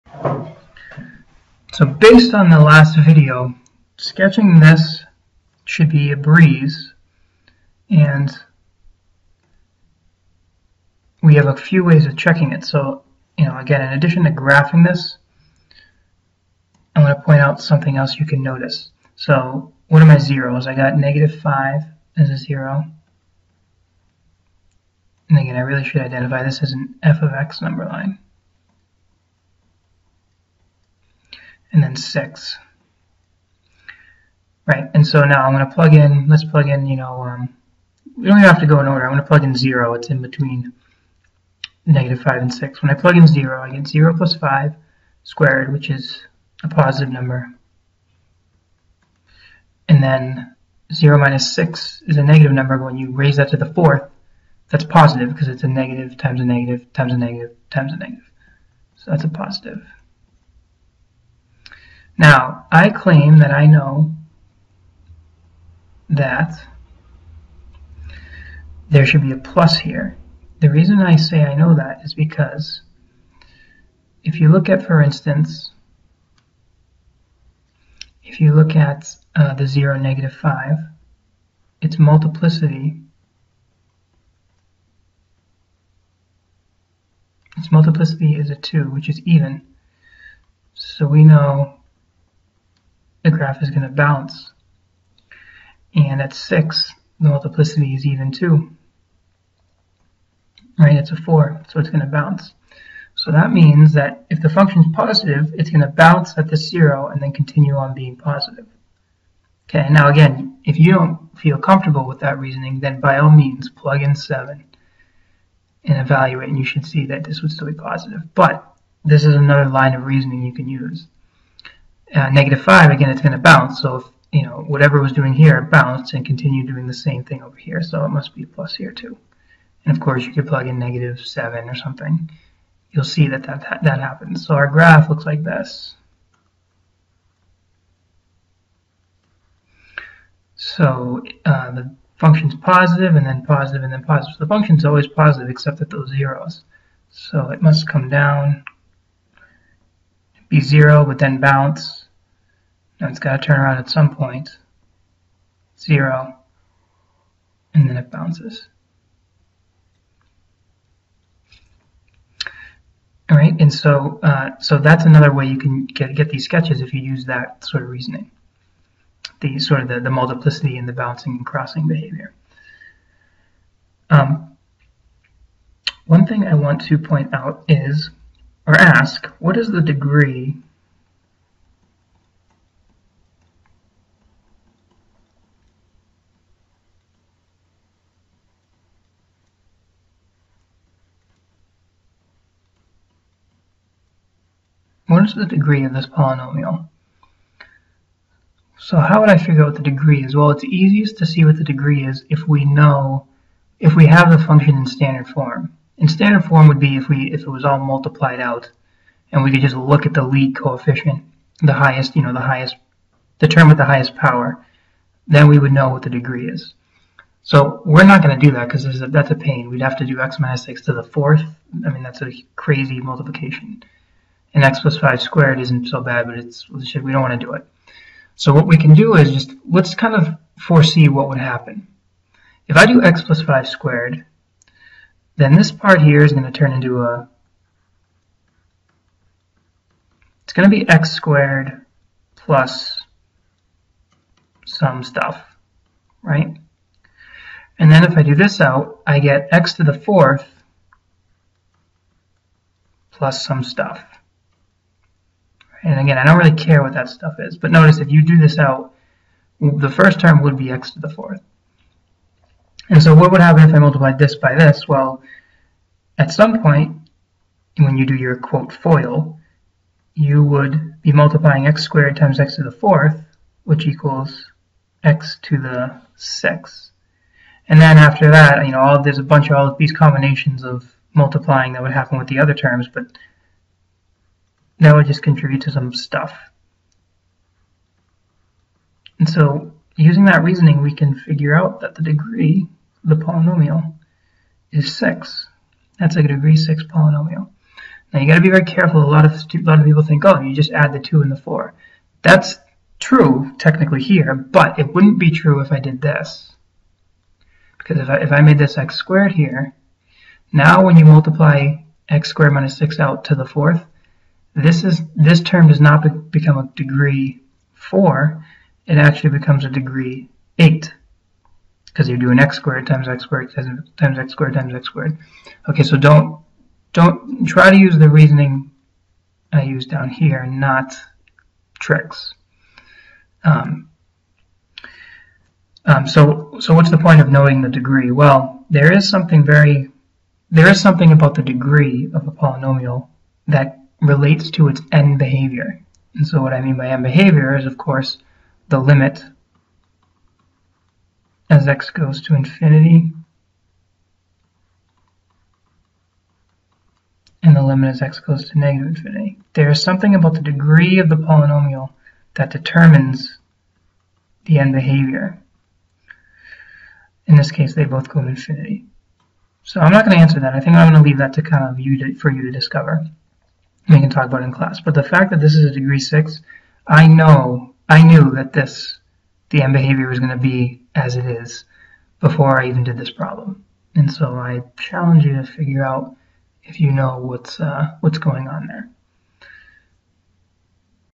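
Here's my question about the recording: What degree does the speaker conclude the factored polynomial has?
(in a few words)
6.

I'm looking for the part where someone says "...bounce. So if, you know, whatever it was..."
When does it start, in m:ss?
2:03.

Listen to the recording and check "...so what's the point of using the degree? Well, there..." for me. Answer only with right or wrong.
wrong.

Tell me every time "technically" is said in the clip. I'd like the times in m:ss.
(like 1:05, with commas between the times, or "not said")
5:03.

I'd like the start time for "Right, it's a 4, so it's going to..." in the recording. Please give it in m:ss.
1:40.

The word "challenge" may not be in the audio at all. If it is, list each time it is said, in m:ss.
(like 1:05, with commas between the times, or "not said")
6:24.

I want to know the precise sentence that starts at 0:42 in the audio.
When I plug in 0, I get 0 plus 5 squared, which is a positive number.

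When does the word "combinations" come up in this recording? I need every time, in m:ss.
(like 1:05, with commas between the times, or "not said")
4:39.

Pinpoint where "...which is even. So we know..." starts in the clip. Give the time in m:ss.
1:28.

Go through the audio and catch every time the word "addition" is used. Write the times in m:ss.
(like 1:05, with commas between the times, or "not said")
0:13.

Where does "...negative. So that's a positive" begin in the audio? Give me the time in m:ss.
0:57.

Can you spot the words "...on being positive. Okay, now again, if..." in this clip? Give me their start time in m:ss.
1:47.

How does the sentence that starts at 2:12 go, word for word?
You'll see that that, that happens.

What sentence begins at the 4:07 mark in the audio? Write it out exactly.
And then if I do this out, I get x to the fourth plus some stuff.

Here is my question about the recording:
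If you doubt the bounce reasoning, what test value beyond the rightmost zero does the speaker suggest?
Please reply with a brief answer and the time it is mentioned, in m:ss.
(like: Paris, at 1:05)
7, at 1:53.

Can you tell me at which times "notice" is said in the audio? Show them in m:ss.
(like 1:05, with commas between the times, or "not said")
0:18, 4:17.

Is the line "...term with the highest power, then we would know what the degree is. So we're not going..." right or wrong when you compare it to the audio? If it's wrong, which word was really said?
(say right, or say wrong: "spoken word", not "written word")
right.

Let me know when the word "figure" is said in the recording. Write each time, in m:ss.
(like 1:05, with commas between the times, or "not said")
3:19, 4:51, 6:25.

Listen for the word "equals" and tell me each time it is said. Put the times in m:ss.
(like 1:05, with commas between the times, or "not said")
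4:33.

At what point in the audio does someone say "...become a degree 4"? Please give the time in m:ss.
5:16.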